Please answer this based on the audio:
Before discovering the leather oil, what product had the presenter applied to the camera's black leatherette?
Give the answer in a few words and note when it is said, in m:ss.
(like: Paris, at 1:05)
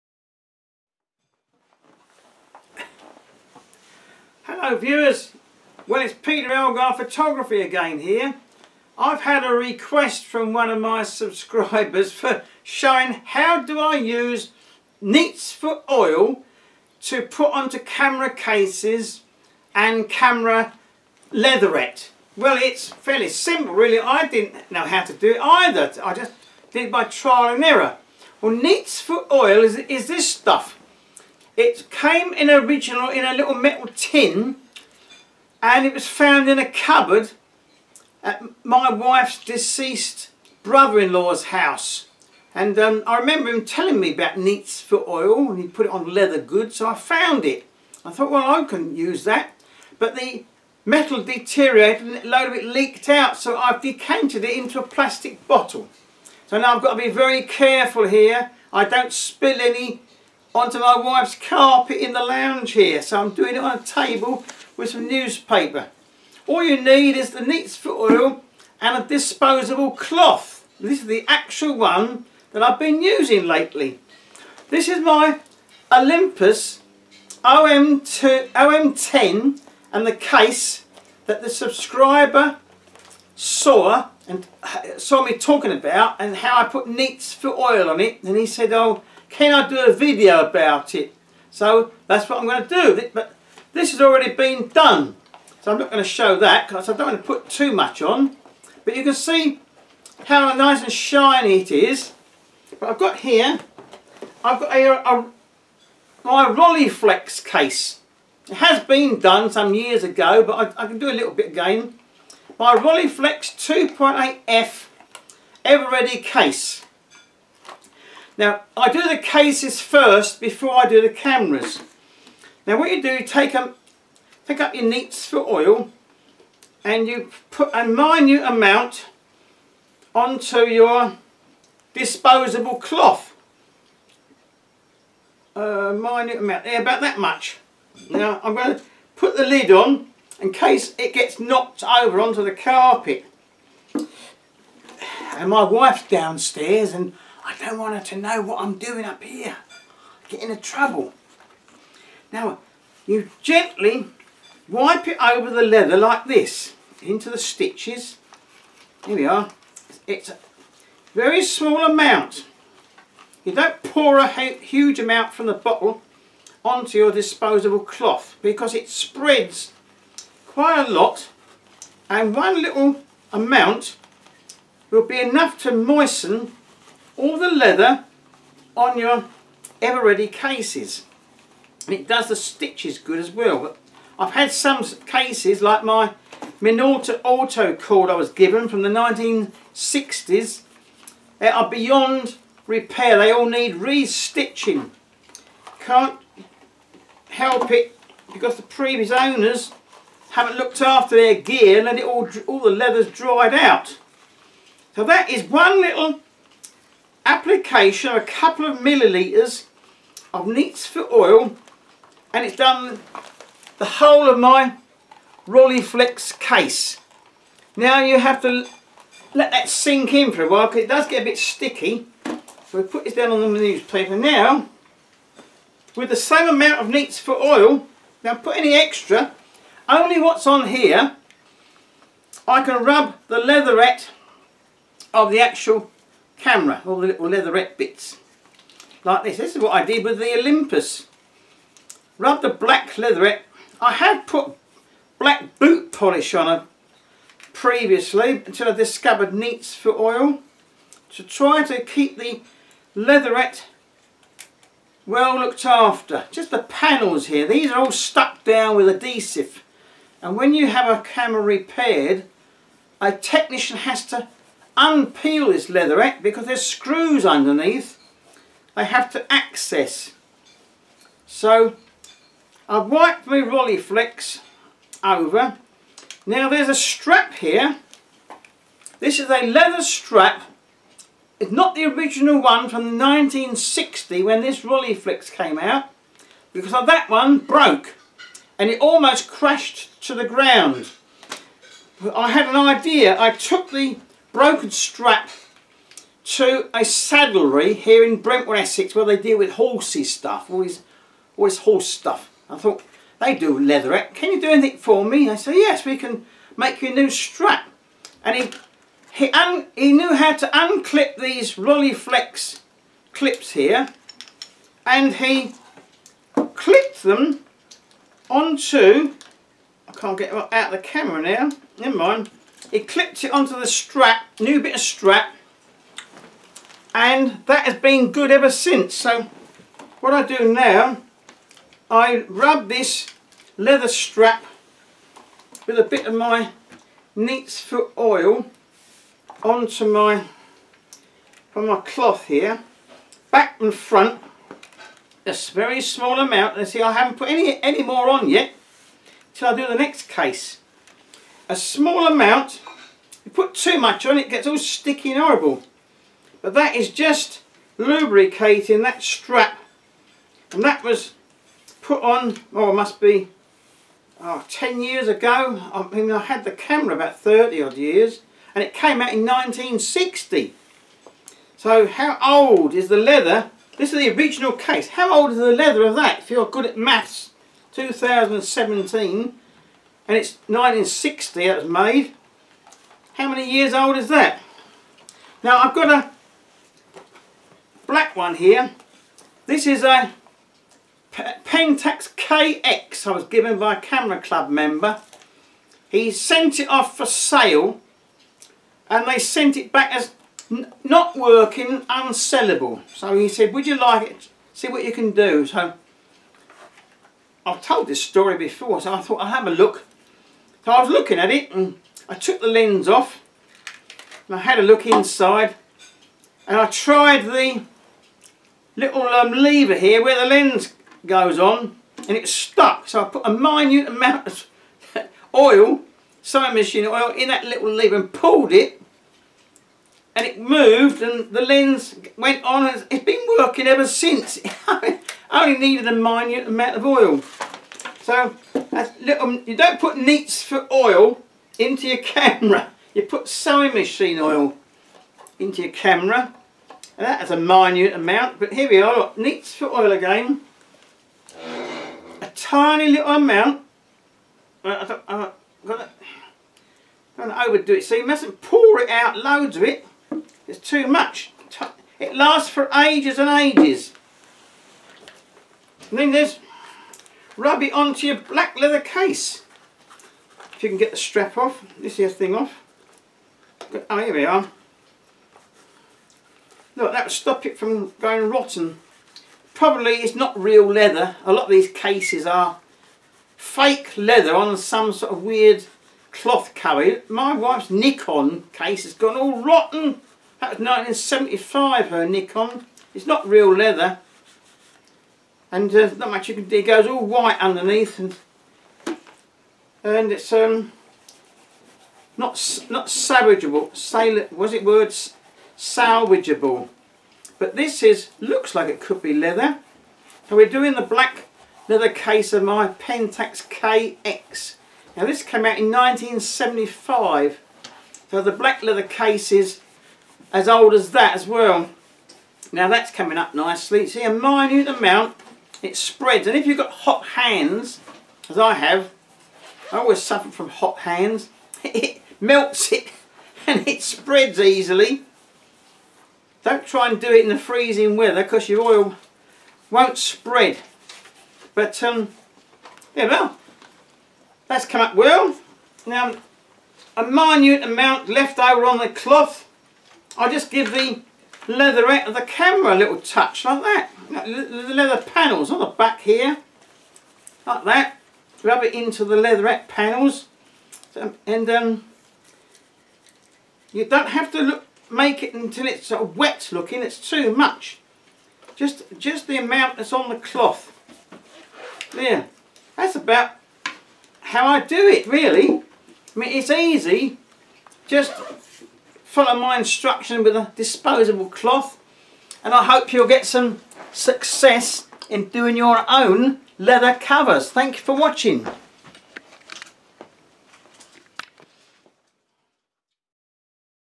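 black boot polish, at 4:05.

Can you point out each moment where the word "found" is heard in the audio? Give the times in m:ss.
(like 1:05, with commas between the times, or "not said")
0:36, 0:46.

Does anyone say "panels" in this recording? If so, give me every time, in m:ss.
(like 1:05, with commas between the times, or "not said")
4:16, 9:15, 9:19.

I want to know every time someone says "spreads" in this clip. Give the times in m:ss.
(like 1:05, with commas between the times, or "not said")
2:48, 8:45, 8:53, 8:59.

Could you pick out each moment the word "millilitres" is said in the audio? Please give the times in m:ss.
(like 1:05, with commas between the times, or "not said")
3:28.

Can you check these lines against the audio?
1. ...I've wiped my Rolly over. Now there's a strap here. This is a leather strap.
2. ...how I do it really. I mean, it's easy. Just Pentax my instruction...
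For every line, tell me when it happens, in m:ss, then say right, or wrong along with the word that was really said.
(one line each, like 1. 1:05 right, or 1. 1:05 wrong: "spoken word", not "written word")
1. 4:32 right
2. 9:34 wrong: "Follow", not "Pentax".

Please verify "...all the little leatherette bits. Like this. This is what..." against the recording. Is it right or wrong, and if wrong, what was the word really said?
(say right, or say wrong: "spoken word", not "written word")
right.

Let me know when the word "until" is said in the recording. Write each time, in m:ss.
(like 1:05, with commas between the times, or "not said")
4:08, 9:25.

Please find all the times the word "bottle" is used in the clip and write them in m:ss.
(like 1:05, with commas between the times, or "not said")
0:55, 2:45.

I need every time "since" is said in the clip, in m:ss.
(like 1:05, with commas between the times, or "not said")
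5:28, 7:13.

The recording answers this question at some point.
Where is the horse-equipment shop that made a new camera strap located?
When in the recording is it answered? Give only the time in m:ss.
4:58.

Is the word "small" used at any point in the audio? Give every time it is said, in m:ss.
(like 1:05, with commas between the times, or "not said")
2:41, 5:45, 5:51.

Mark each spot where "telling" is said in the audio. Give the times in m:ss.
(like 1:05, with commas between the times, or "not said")
0:43.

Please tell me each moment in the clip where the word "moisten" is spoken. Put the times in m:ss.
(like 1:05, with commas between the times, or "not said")
2:55.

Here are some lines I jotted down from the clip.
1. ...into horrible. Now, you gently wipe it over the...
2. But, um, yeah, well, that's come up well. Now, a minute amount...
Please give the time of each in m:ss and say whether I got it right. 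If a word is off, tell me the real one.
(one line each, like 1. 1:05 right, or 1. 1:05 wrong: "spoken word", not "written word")
1. 2:30 wrong: "trouble", not "horrible"
2. 9:01 right.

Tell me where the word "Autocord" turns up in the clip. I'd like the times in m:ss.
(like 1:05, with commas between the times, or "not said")
3:07.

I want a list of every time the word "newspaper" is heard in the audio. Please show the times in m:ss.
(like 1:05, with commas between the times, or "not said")
1:05, 3:43.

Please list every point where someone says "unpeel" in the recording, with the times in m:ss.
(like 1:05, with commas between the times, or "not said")
4:24.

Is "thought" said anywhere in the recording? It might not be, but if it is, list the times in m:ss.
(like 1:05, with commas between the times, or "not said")
0:48, 5:02, 6:49.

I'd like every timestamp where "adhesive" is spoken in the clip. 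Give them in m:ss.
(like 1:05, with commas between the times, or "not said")
4:18.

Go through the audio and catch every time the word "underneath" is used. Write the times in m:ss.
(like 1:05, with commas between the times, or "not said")
4:27, 8:17.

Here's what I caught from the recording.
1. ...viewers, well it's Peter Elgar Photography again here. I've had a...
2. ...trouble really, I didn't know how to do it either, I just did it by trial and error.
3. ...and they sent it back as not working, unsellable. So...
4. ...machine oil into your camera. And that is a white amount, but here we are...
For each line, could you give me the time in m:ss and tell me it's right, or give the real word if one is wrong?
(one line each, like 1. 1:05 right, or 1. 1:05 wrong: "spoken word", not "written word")
1. 0:04 right
2. 0:23 wrong: "simple", not "trouble"
3. 6:38 right
4. 7:23 wrong: "minute", not "white".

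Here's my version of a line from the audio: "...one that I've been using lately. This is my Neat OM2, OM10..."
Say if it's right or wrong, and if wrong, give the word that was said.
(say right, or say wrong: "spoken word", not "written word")
wrong: "Olympus", not "Neat".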